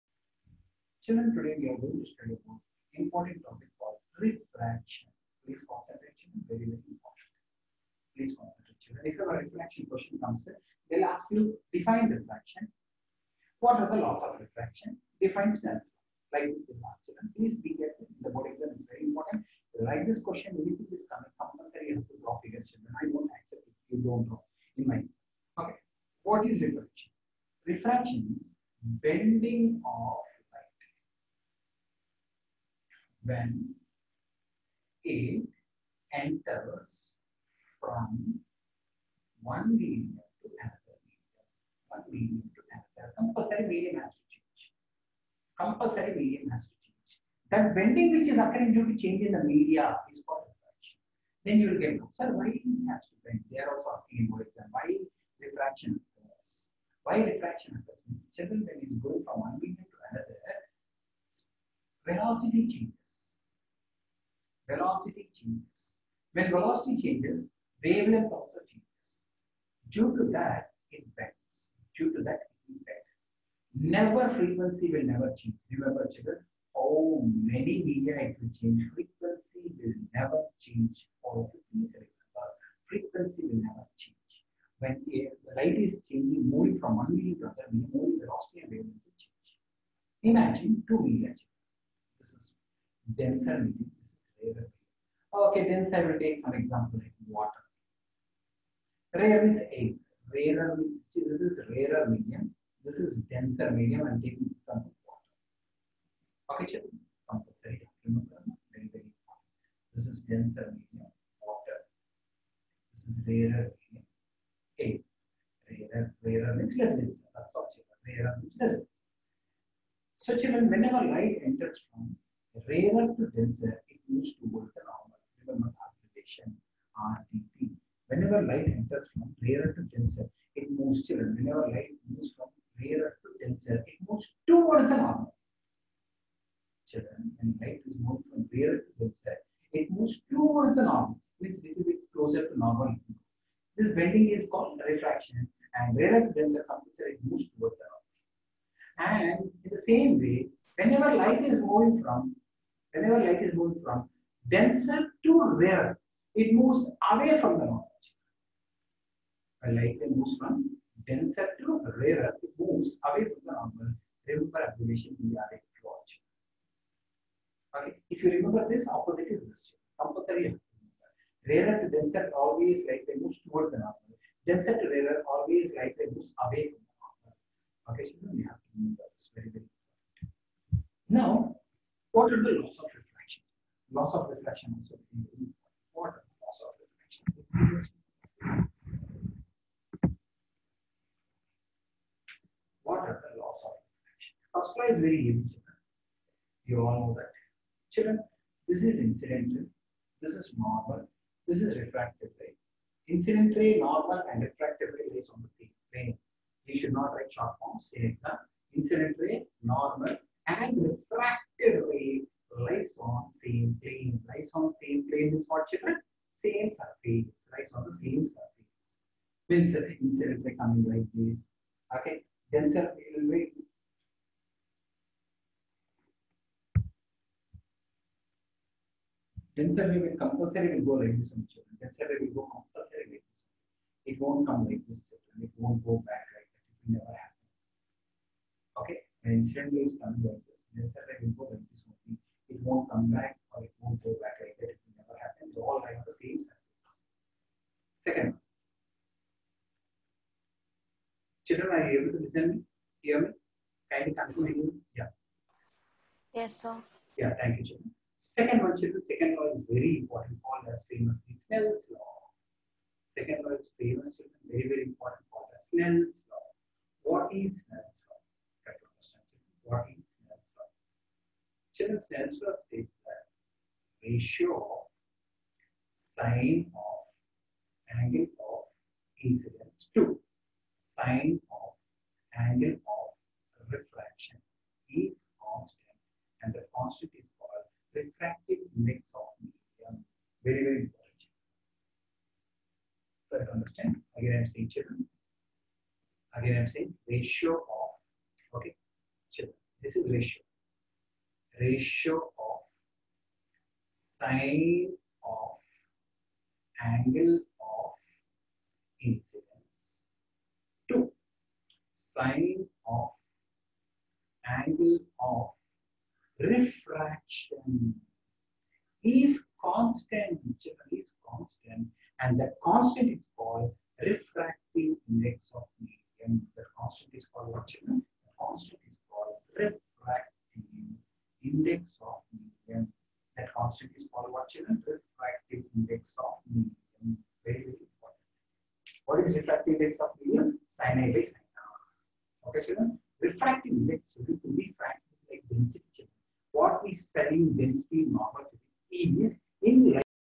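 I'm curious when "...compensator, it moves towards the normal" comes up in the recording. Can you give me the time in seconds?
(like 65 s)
146 s.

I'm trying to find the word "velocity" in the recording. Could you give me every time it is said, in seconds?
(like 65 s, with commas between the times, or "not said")
62 s, 66 s, 88 s.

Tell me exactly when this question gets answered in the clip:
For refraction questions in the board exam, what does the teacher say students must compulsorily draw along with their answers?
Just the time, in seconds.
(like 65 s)
22 s.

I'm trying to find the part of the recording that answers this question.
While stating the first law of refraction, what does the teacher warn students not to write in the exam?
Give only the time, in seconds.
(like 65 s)
207 s.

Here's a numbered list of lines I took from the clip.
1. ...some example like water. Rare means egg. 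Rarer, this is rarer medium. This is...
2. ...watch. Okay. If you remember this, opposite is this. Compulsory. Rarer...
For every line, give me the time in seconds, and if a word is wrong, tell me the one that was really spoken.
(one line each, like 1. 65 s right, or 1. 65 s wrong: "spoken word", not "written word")
1. 96 s right
2. 165 s right.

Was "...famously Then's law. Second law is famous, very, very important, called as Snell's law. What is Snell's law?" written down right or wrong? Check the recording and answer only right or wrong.
wrong.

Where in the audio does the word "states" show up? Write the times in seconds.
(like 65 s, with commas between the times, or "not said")
272 s.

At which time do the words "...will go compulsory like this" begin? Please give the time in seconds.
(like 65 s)
232 s.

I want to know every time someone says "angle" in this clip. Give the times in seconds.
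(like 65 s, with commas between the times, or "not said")
278 s, 282 s, 306 s, 314 s.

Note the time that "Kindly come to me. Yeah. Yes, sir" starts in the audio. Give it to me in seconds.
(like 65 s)
253 s.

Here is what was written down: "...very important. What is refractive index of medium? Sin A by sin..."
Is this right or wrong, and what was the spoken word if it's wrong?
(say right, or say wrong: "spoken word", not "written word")
right.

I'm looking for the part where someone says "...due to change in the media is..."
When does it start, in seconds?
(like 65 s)
48 s.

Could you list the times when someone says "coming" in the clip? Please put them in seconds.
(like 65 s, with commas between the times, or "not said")
21 s, 220 s, 239 s.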